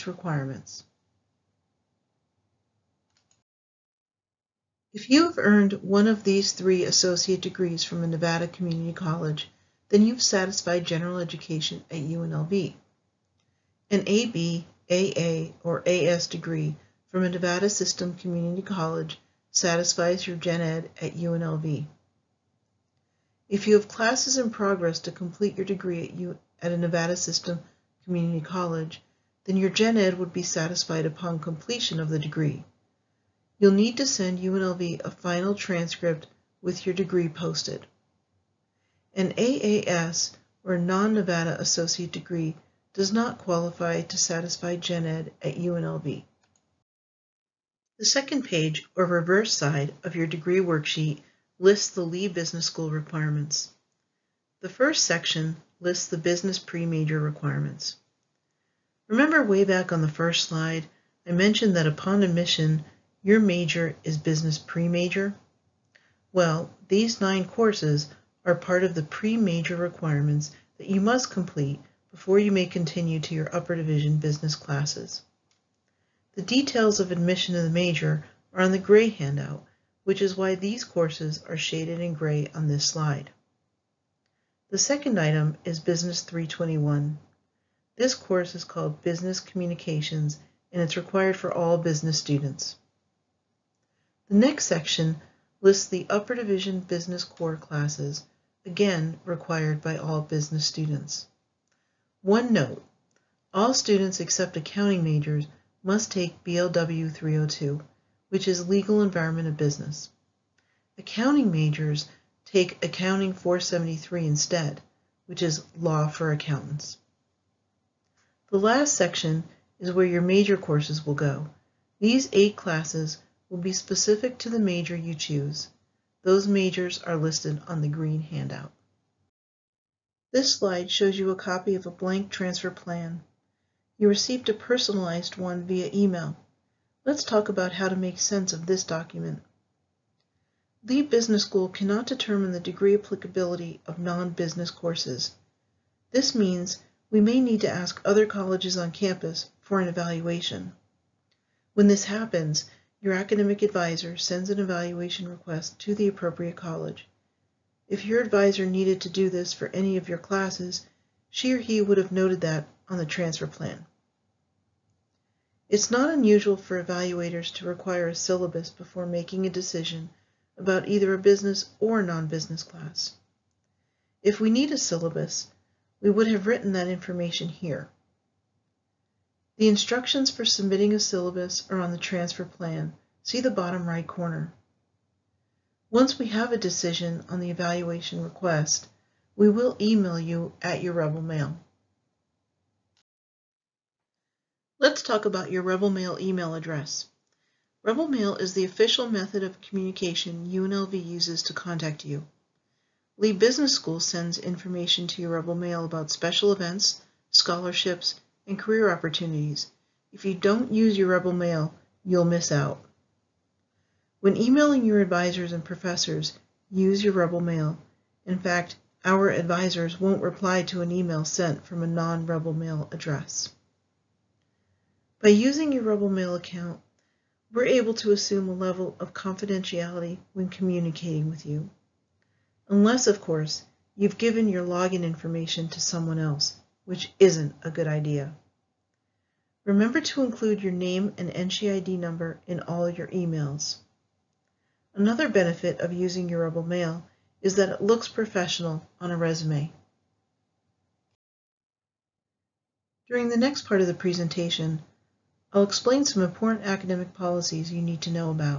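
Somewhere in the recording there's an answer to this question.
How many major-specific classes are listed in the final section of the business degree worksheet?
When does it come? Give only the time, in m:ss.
2:02.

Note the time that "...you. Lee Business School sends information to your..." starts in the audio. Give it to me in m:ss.
3:22.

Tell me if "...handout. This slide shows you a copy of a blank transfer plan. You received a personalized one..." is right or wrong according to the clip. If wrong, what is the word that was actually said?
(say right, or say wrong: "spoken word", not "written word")
right.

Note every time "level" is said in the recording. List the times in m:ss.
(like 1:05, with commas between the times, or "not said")
3:48.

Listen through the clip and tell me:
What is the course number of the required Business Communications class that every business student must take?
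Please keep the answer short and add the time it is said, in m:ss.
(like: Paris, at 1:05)
Business 321, at 1:25.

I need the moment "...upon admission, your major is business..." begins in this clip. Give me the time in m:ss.
1:01.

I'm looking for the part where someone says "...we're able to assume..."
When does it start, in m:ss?
3:47.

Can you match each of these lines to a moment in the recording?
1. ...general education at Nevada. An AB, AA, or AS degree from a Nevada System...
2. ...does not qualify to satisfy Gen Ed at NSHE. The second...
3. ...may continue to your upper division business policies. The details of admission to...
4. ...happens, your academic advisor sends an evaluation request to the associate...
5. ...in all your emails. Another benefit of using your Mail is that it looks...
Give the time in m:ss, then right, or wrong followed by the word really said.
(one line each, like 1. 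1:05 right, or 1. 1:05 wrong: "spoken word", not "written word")
1. 0:10 wrong: "UNLV", not "Nevada"
2. 0:42 wrong: "UNLV", not "NSHE"
3. 1:12 wrong: "classes", not "policies"
4. 2:32 wrong: "appropriate", not "associate"
5. 4:02 right.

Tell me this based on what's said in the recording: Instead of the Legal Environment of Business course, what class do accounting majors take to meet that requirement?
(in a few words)
Accounting 473.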